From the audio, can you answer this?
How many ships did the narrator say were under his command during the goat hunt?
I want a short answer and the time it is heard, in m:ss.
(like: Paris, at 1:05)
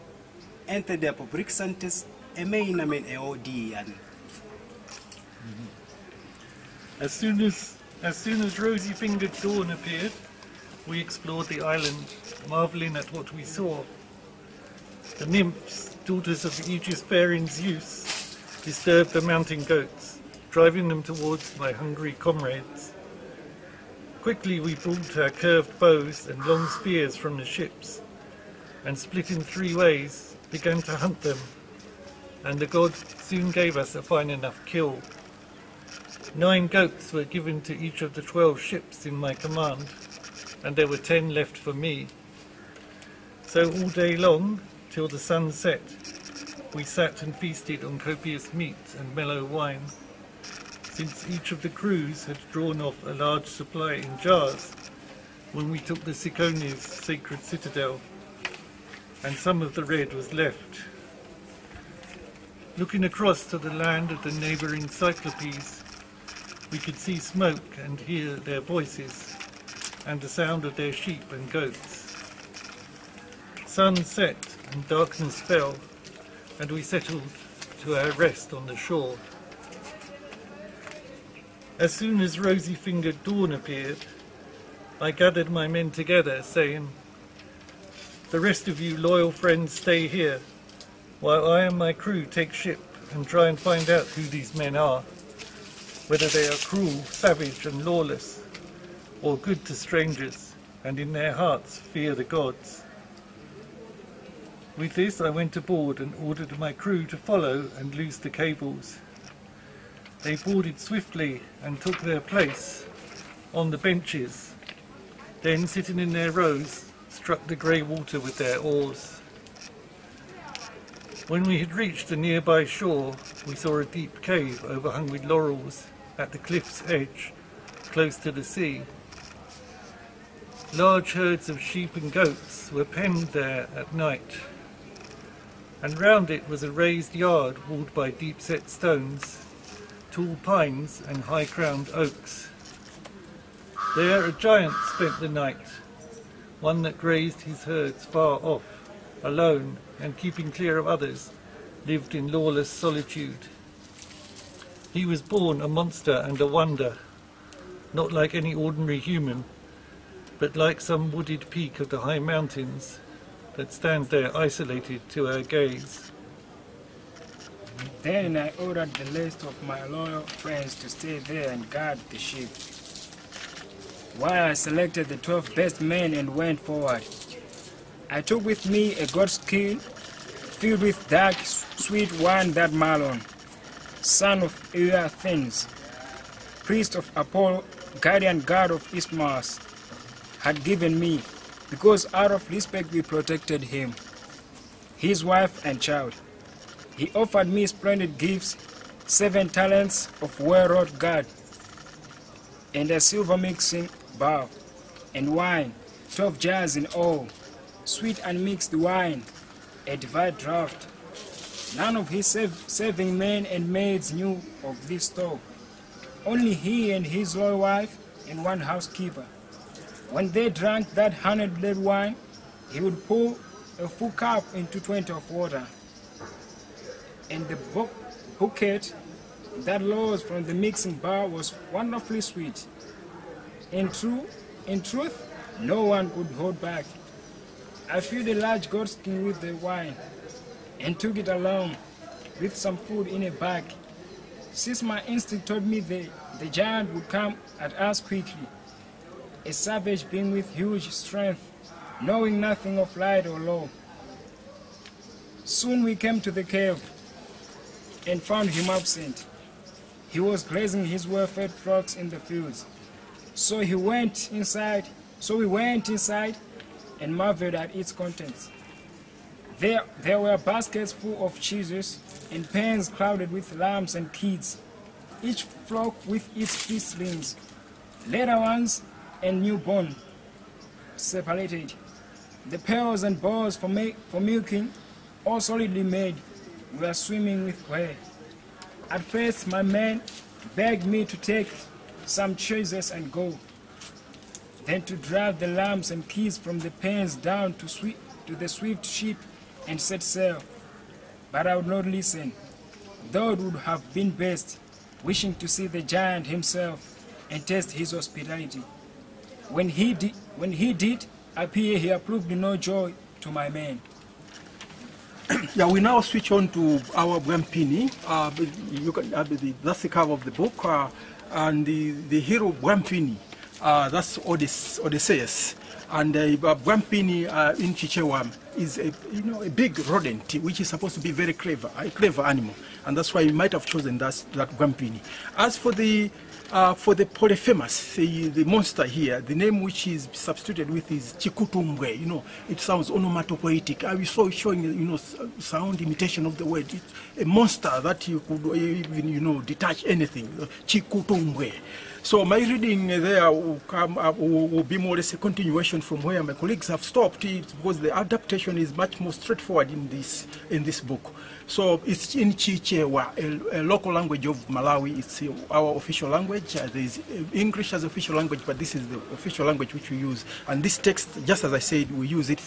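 12, at 0:38.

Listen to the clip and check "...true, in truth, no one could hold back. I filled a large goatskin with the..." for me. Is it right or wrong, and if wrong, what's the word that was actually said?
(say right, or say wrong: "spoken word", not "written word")
right.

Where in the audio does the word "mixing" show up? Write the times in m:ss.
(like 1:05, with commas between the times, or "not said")
3:23, 3:50.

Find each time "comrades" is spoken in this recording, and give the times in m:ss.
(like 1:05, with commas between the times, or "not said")
0:22.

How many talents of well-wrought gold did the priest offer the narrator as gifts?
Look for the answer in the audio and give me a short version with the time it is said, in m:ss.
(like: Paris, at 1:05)
7, at 3:19.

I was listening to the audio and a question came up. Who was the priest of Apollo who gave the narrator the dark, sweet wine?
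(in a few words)
Malon.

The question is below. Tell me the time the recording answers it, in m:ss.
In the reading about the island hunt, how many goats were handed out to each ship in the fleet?
0:36.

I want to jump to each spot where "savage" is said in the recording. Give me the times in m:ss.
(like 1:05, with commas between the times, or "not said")
1:37, 4:09.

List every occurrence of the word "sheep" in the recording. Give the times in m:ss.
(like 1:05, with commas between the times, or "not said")
1:10, 2:11.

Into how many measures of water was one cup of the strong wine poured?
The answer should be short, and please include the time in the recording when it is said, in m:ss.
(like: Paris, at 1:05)
20, at 3:44.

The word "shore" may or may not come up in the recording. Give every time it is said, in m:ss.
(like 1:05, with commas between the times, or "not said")
1:18, 2:02.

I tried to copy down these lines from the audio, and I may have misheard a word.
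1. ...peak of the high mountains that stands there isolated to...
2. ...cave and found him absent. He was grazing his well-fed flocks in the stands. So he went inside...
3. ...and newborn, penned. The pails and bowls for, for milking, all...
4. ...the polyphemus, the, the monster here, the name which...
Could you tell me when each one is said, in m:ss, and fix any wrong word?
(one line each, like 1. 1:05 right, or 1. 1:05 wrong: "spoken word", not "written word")
1. 2:41 right
2. 4:16 wrong: "fields", not "stands"
3. 4:39 wrong: "separated", not "penned"
4. 5:36 right.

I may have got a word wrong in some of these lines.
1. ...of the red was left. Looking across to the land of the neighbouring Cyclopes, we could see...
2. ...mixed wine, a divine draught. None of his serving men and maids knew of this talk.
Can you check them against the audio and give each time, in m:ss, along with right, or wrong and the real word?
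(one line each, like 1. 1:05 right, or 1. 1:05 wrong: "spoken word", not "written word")
1. 0:59 right
2. 3:28 right.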